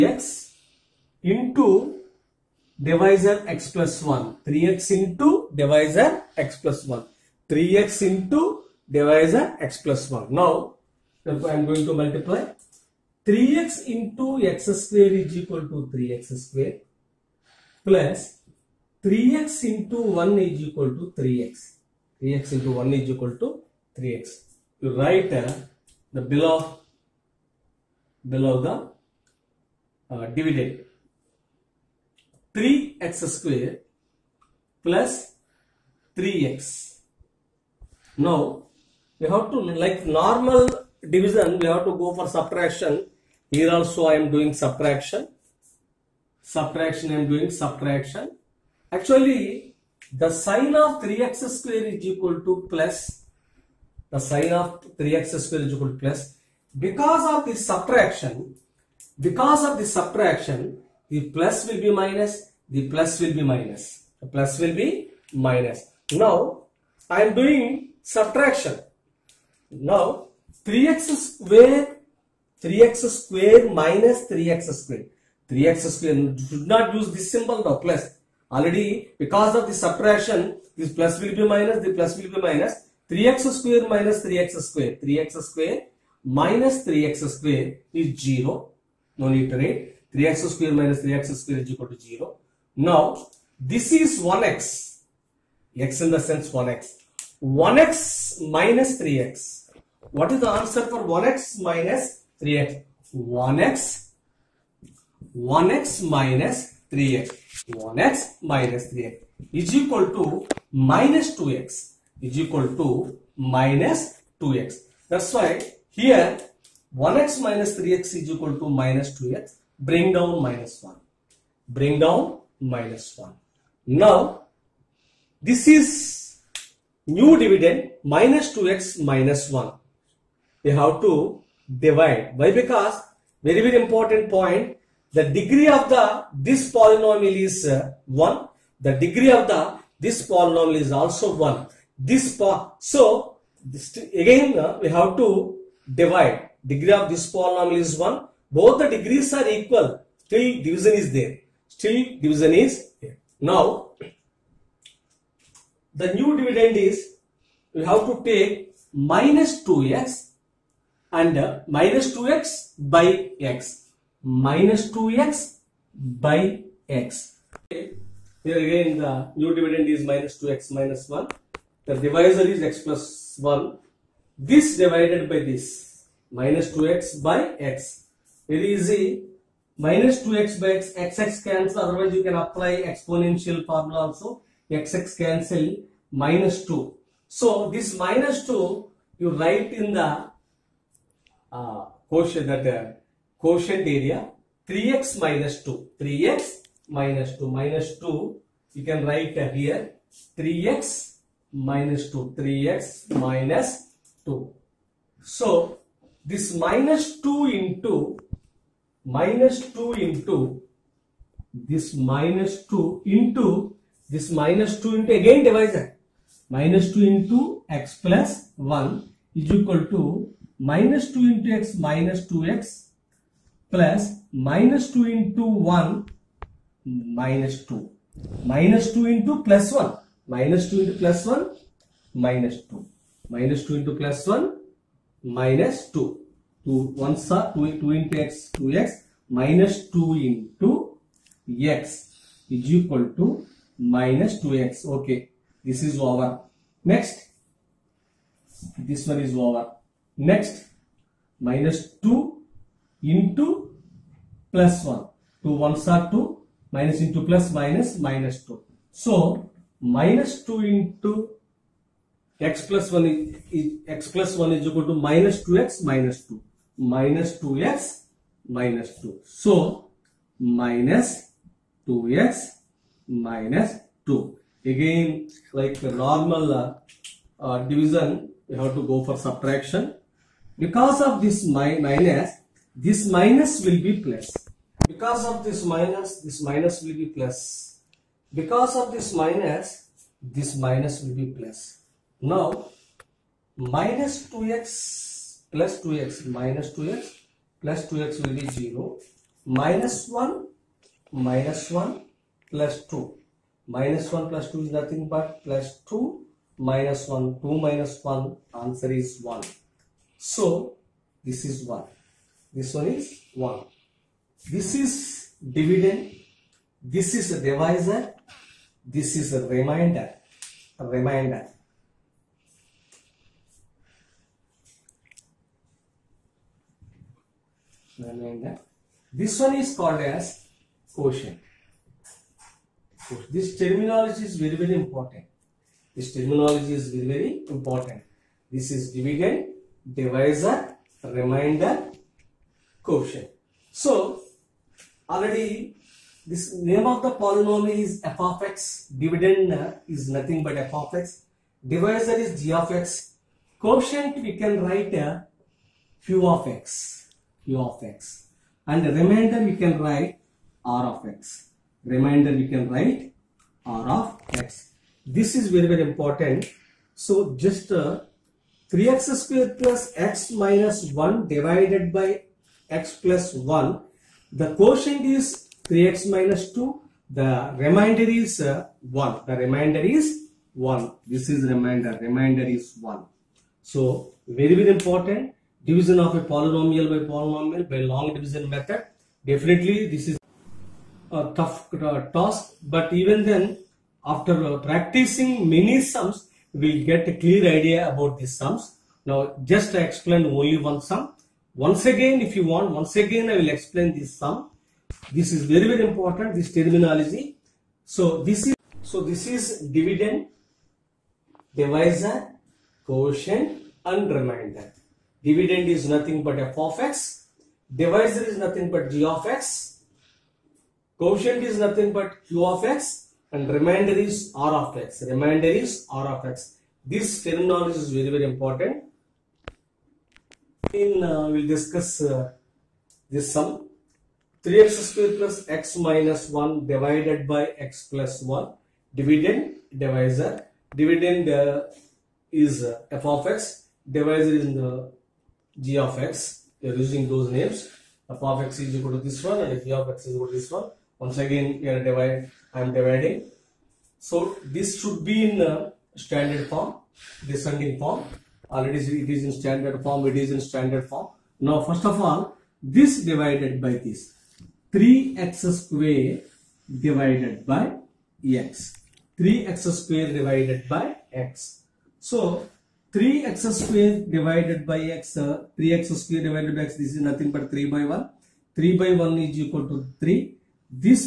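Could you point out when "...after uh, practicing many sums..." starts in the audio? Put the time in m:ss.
6:34.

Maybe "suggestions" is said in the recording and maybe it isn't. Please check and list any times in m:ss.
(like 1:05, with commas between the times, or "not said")
not said.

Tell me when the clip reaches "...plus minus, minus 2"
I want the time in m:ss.
4:17.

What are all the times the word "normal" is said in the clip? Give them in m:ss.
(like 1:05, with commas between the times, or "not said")
0:40, 4:35.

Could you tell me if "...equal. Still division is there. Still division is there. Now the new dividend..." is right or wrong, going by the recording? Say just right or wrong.
right.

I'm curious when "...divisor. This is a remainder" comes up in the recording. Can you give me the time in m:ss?
5:17.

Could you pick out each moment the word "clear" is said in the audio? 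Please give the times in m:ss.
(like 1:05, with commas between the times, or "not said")
6:37.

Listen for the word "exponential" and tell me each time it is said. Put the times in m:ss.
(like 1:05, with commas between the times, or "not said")
3:02.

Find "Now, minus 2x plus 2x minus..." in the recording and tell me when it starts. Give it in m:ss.
4:52.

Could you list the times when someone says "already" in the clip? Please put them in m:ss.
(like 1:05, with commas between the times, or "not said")
1:18, 5:45, 7:38.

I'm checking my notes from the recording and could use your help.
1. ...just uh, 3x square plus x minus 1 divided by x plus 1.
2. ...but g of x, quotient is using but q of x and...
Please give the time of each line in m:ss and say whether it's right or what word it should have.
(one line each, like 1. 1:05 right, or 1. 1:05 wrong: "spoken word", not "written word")
1. 6:07 right
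2. 6:58 wrong: "nothing", not "using".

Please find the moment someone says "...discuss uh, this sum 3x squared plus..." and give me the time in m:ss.
7:11.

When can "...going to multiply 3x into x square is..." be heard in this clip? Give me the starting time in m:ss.
0:11.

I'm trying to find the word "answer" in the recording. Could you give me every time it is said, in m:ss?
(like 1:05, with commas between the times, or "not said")
1:40, 5:08.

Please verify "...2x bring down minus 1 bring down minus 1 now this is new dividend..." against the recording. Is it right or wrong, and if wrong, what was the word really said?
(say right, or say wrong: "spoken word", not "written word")
right.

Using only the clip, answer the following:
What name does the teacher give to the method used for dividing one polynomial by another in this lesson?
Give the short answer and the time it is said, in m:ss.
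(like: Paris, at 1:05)
long division method, at 6:27.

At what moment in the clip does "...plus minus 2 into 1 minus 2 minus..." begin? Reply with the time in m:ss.
3:43.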